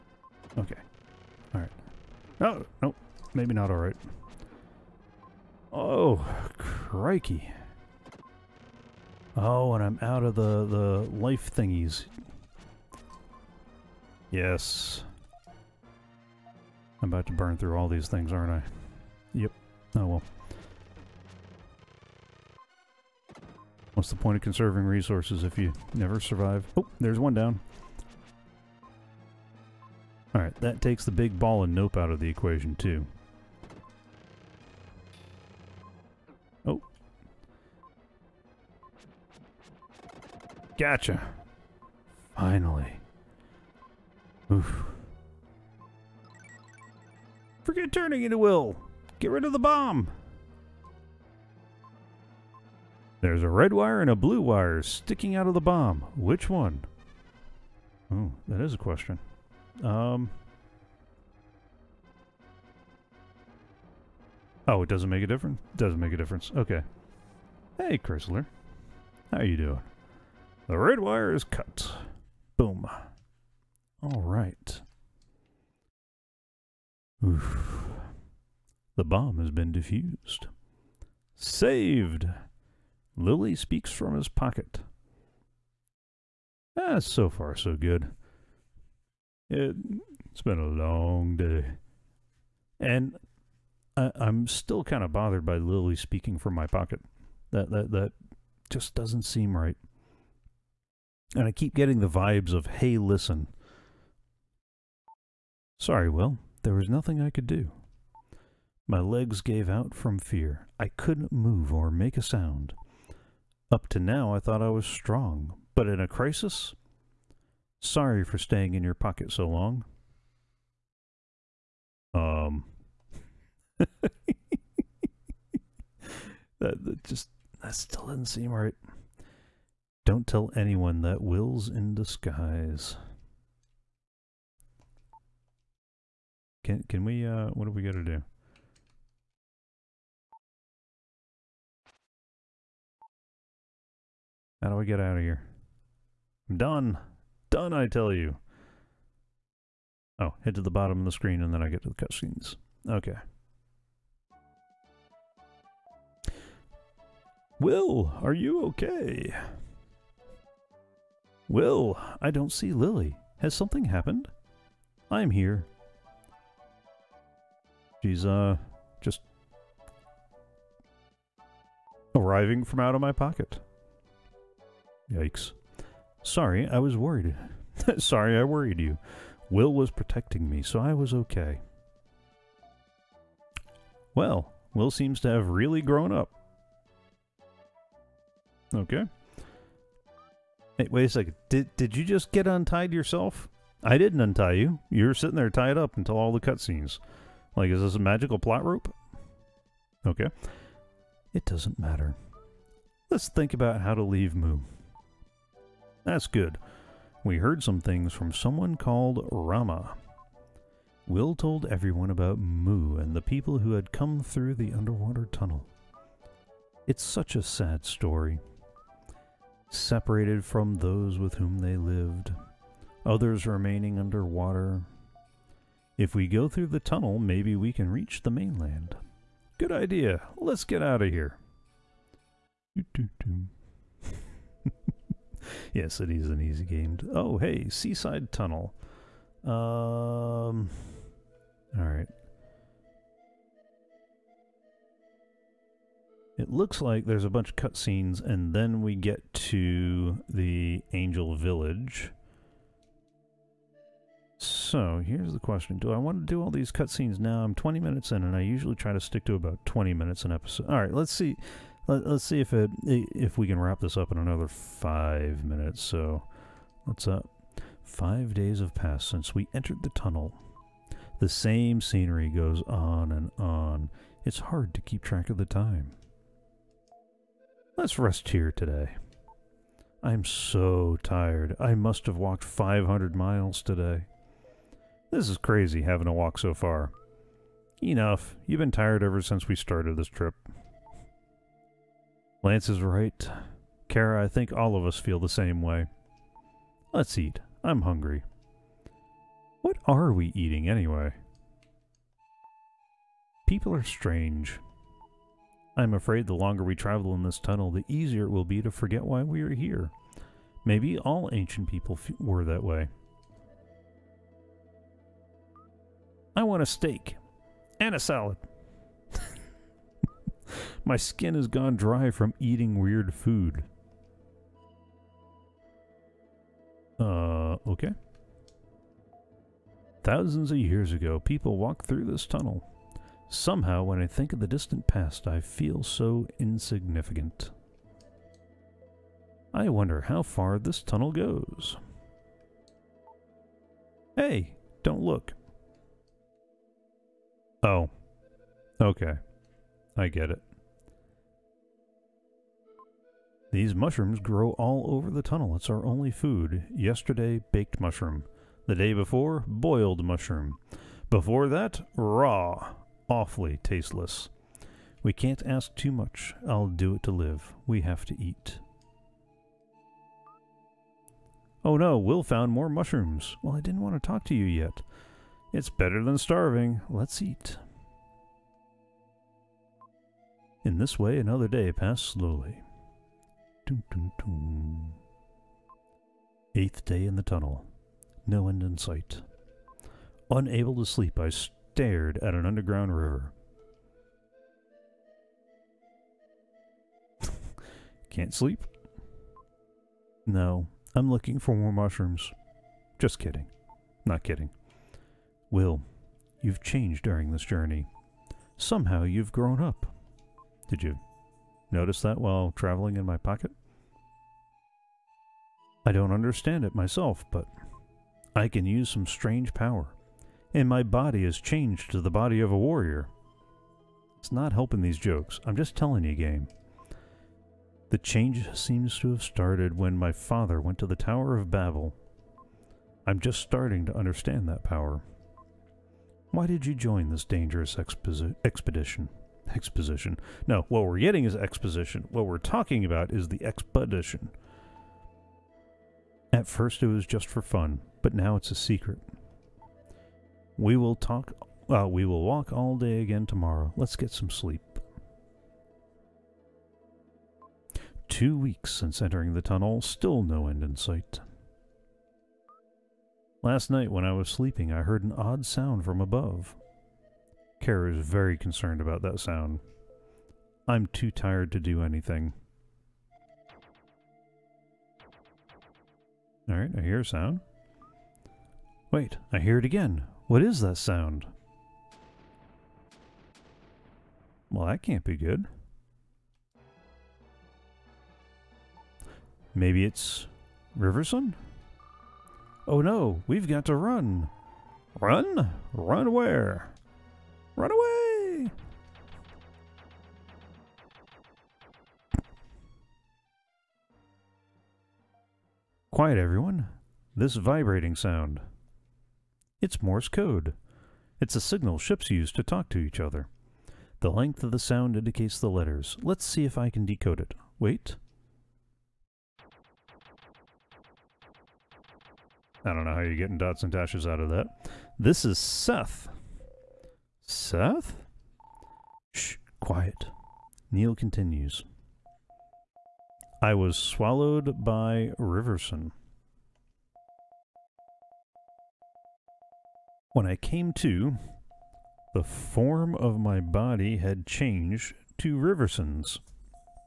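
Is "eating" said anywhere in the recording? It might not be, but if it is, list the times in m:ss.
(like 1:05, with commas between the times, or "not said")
5:00, 5:22.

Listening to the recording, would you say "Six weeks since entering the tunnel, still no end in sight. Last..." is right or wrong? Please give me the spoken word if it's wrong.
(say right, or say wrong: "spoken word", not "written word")
wrong: "Two", not "Six".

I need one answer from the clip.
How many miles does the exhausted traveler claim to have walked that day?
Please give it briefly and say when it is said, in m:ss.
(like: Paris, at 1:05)
500, at 4:42.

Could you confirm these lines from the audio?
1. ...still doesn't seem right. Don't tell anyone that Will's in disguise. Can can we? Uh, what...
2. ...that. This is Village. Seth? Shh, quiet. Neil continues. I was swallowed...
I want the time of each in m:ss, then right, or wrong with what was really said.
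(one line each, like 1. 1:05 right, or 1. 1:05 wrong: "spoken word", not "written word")
1. 2:07 right
2. 8:44 wrong: "Seth", not "Village".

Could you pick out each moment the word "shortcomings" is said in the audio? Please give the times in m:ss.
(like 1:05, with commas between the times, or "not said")
not said.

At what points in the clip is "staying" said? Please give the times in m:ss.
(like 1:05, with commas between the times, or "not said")
1:58.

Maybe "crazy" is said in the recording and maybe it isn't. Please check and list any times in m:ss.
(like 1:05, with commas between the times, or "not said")
4:45.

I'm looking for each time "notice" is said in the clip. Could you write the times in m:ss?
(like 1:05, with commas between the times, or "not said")
6:51.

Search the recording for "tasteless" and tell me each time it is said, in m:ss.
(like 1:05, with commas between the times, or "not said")
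6:03.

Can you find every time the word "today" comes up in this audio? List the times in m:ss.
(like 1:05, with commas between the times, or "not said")
4:38, 4:43.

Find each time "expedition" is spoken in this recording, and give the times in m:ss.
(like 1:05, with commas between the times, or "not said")
7:18, 7:23.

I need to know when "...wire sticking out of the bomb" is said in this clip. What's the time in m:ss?
0:54.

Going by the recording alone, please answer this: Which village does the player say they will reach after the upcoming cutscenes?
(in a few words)
Angel Village.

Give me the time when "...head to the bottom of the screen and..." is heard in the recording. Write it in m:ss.
2:30.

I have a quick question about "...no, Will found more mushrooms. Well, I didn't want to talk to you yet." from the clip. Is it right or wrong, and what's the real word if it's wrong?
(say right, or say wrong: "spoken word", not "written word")
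right.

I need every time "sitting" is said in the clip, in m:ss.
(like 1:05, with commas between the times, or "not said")
3:15.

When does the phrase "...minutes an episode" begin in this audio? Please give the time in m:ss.
4:19.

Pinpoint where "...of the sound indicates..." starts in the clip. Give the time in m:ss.
8:34.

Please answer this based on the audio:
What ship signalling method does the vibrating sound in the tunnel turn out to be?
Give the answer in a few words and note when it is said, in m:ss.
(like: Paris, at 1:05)
Morse code, at 8:29.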